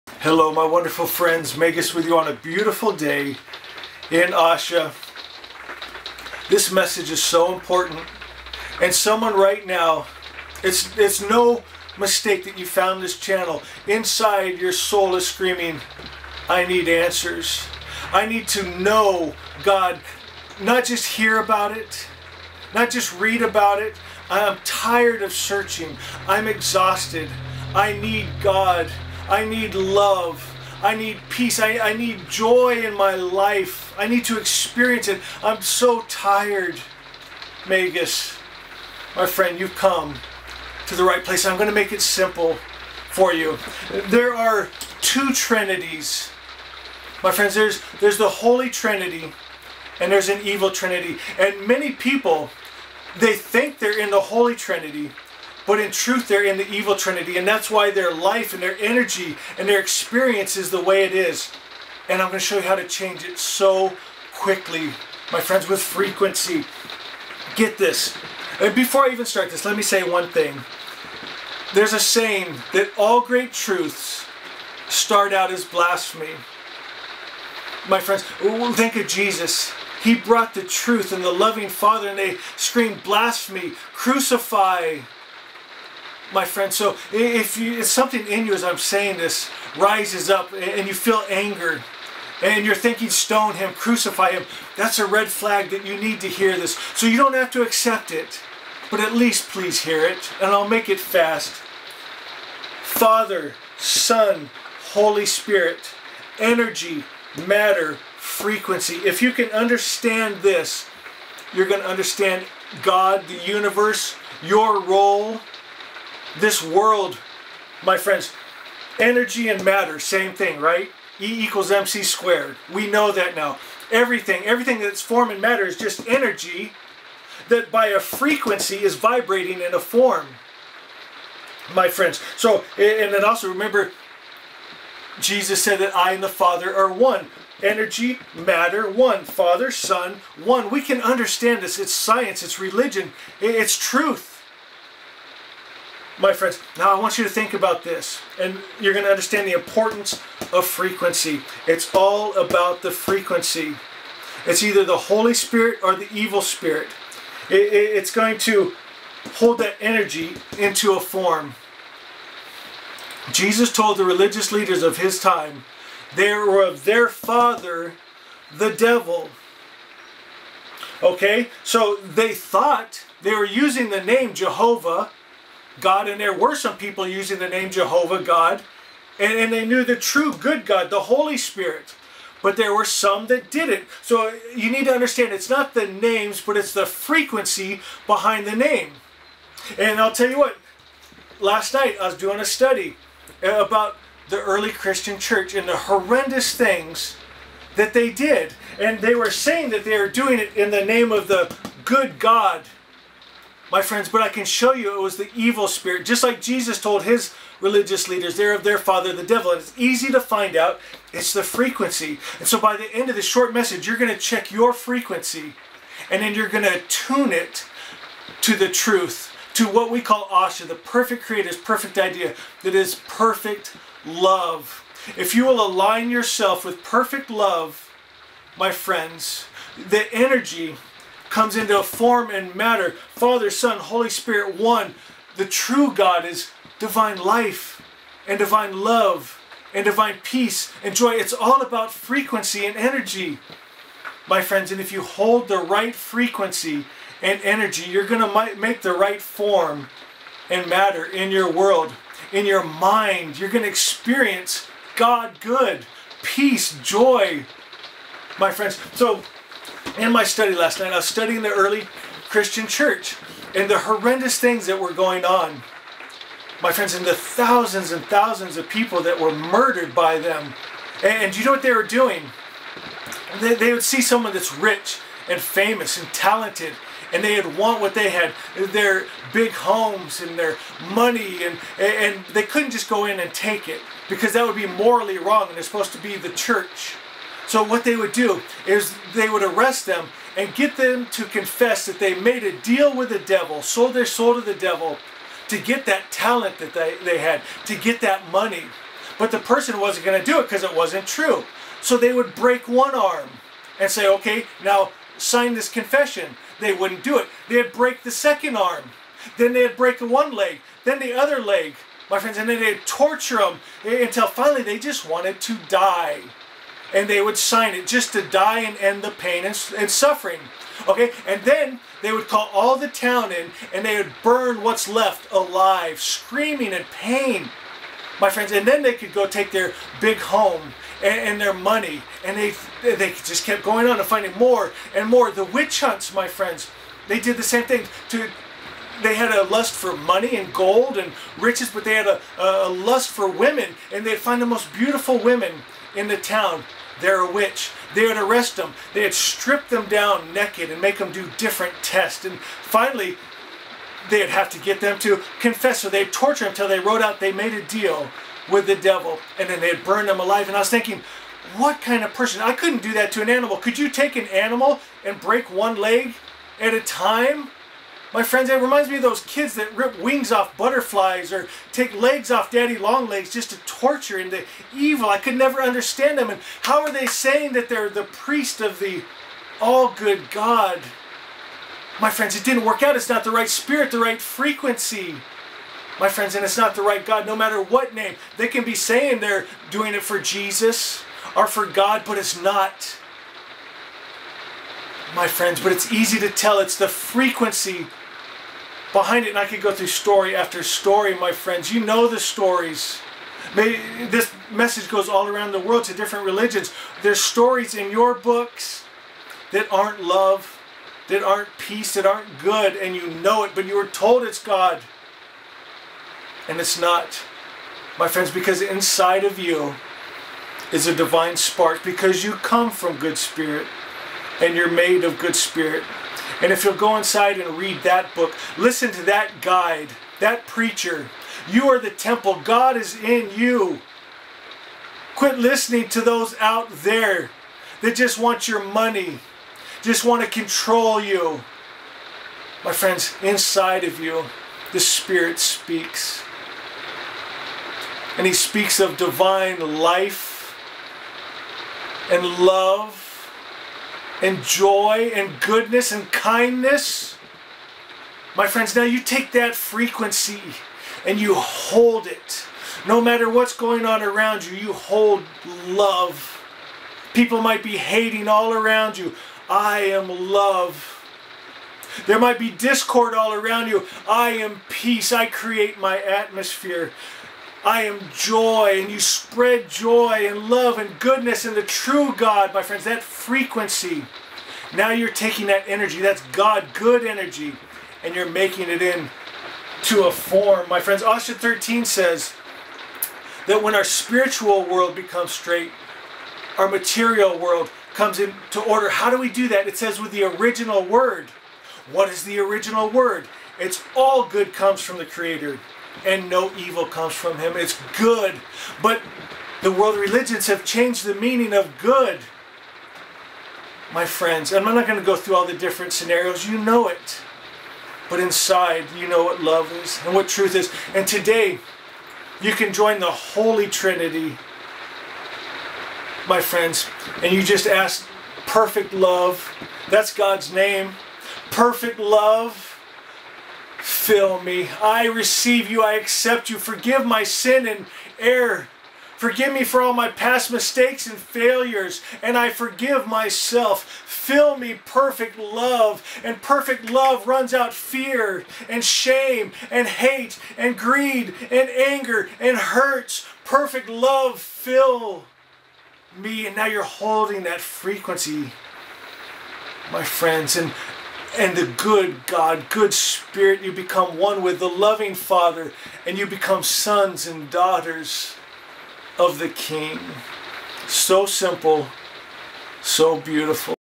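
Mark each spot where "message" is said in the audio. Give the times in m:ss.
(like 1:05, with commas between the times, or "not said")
0:06, 3:33, 6:44.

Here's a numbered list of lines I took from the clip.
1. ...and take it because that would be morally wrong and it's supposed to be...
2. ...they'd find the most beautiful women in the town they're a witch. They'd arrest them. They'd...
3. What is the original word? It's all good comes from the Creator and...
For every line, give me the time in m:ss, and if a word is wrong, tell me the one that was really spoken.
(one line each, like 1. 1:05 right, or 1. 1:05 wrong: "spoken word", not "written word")
1. 4:43 right
2. 5:44 right
3. 8:21 right.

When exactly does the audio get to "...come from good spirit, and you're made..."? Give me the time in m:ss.
7:02.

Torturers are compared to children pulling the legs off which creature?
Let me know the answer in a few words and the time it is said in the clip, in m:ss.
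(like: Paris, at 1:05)
Daddy long legs, at 6:12.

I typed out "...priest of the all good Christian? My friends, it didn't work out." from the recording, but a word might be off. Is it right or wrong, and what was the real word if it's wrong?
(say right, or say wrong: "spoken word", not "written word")
wrong: "God", not "Christian".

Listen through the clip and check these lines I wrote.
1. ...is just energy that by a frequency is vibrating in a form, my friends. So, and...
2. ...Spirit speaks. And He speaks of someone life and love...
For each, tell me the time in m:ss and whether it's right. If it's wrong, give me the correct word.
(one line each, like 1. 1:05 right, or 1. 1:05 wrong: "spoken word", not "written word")
1. 2:05 right
2. 7:24 wrong: "divine", not "someone".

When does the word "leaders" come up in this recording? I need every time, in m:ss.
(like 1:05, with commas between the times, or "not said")
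2:44, 3:28.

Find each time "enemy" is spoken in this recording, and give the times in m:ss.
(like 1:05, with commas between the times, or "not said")
not said.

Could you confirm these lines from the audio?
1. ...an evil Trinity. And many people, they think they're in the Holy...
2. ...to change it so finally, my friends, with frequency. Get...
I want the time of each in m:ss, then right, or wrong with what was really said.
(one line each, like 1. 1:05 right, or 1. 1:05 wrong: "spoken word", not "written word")
1. 0:50 right
2. 1:02 wrong: "quickly", not "finally".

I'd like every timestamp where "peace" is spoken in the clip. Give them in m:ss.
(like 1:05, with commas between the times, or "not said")
0:31, 4:00, 4:16, 6:51, 7:54.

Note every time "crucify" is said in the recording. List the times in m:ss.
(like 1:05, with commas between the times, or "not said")
1:23, 1:33.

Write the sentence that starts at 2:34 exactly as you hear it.
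It's either the Holy Spirit or the evil spirit.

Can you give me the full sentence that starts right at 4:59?
But the person wasn't going to do it because it wasn't true.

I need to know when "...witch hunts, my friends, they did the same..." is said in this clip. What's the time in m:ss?
5:35.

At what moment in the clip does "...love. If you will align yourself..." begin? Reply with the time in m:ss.
3:44.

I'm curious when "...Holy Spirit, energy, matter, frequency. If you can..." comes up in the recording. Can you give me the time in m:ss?
1:44.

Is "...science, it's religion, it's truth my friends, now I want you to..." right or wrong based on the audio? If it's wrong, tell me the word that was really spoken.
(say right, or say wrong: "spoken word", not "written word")
right.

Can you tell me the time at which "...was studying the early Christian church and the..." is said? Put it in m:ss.
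4:20.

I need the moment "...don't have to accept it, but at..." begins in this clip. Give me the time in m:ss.
1:37.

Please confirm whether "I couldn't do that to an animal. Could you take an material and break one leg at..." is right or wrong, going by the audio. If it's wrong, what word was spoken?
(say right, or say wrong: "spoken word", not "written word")
wrong: "animal", not "material".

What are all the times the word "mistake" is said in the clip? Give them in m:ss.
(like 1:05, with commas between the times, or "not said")
0:11, 9:00.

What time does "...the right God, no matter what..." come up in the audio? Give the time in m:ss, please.
6:26.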